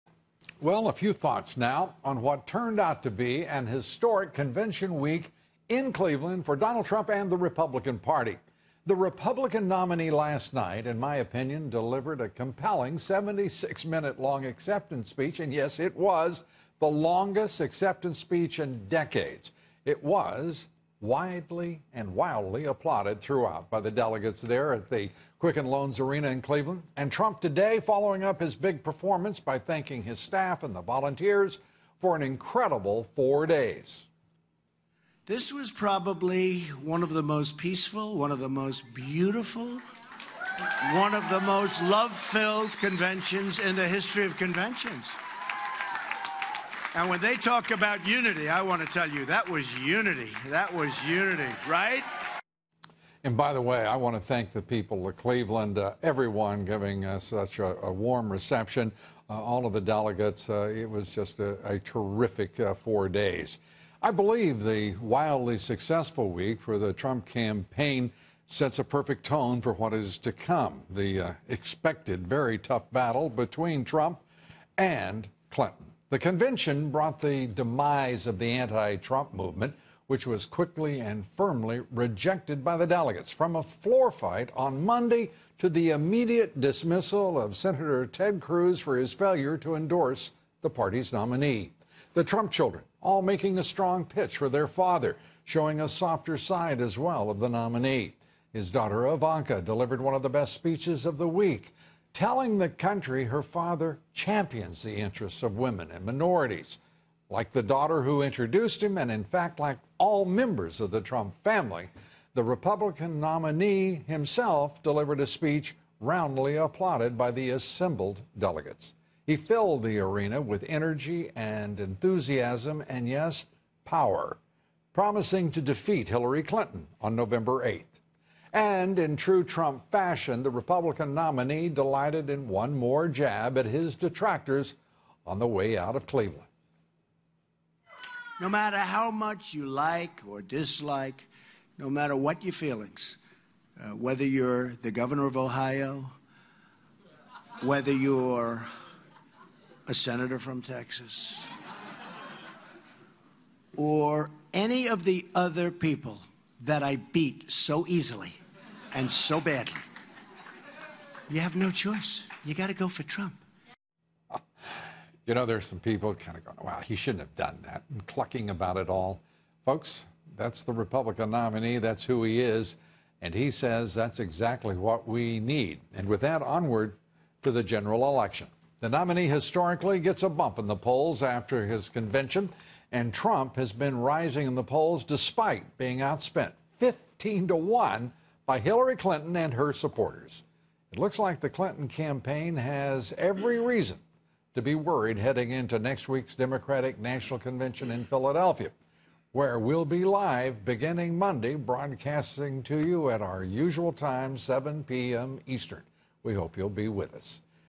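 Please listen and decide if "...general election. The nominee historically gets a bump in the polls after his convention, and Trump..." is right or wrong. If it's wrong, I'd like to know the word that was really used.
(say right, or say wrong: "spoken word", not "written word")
right.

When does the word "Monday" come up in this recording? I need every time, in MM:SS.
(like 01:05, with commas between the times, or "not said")
01:24, 03:21.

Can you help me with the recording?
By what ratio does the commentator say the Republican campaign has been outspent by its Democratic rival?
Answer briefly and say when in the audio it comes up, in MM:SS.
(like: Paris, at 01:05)
15 to 1, at 03:06.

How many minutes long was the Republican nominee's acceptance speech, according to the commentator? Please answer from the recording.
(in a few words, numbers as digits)
76.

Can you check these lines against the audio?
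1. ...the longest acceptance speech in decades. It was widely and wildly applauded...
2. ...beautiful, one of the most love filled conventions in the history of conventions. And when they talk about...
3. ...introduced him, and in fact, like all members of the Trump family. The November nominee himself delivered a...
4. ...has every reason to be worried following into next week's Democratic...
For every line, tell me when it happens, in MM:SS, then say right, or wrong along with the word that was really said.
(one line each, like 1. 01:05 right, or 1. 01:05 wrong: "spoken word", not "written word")
1. 00:16 right
2. 00:38 right
3. 01:48 wrong: "Republican", not "November"
4. 03:12 wrong: "heading", not "following".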